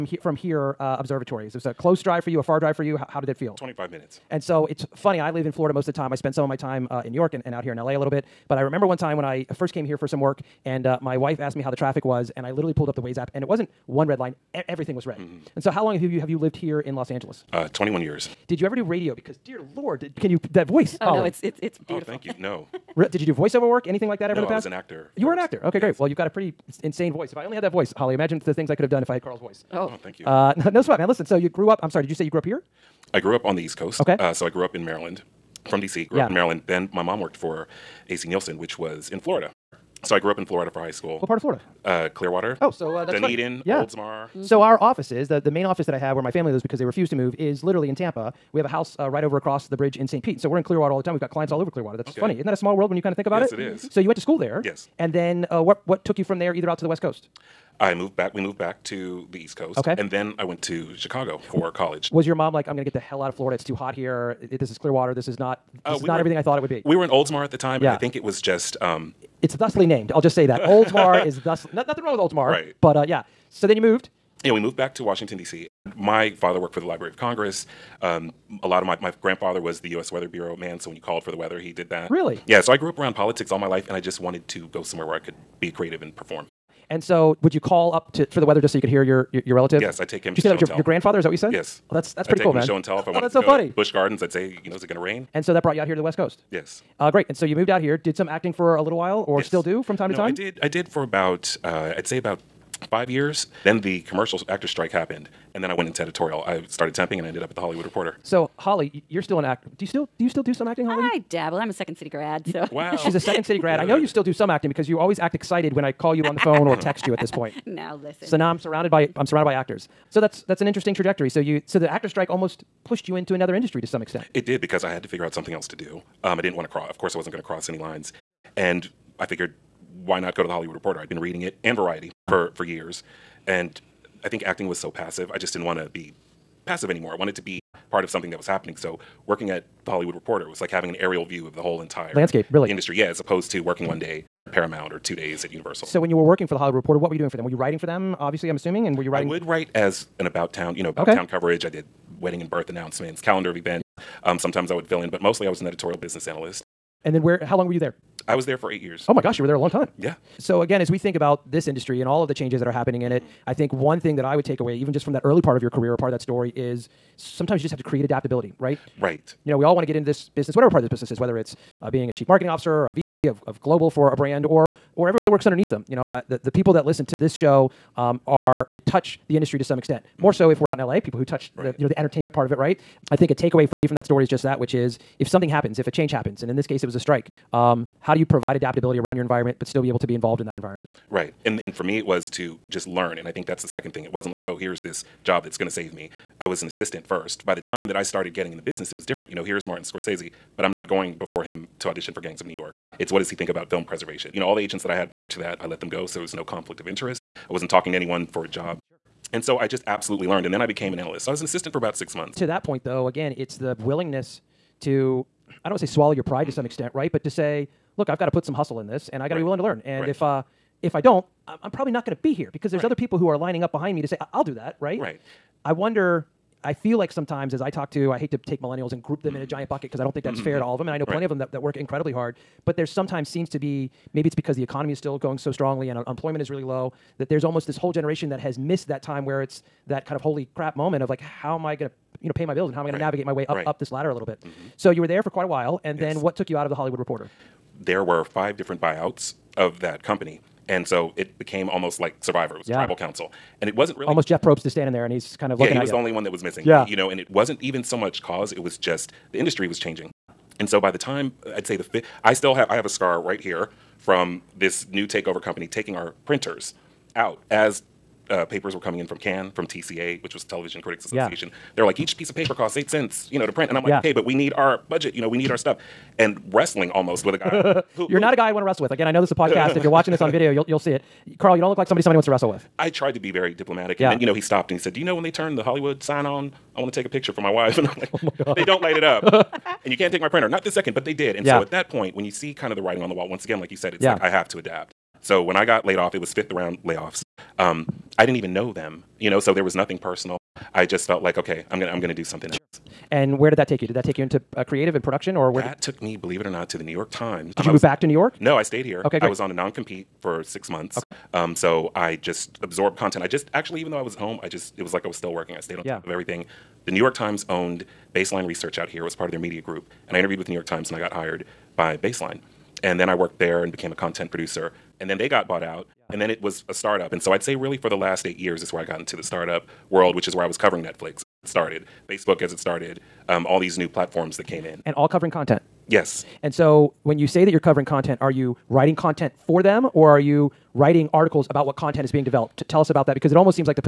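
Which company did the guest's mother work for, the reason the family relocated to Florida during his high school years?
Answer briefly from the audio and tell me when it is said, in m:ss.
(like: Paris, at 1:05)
AC Nielsen, at 0:38.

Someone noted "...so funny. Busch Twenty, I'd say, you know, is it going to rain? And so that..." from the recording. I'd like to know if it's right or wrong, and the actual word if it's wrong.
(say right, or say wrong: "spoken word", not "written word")
wrong: "Gardens", not "Twenty".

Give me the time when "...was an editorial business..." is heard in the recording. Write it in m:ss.
2:35.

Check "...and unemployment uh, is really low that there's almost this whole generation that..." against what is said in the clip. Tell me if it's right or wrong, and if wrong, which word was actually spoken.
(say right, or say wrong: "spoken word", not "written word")
right.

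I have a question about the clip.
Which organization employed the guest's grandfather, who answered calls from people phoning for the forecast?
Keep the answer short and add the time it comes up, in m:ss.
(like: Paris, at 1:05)
U.S. Weather Bureau, at 1:19.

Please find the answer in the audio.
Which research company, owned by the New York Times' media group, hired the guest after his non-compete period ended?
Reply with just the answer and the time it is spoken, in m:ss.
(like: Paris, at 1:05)
Baseline Research, at 5:18.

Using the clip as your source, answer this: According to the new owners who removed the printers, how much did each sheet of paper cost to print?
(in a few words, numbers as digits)
8 cents.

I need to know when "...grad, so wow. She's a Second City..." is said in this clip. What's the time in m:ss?
1:52.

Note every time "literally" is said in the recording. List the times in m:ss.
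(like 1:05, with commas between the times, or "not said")
0:12, 0:47.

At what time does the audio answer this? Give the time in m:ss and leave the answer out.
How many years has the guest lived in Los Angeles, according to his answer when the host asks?
0:17.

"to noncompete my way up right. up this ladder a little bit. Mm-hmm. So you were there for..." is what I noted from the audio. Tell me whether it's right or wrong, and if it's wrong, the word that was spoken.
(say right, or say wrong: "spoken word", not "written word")
wrong: "navigate", not "noncompete".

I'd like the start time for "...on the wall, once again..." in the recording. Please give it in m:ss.
4:53.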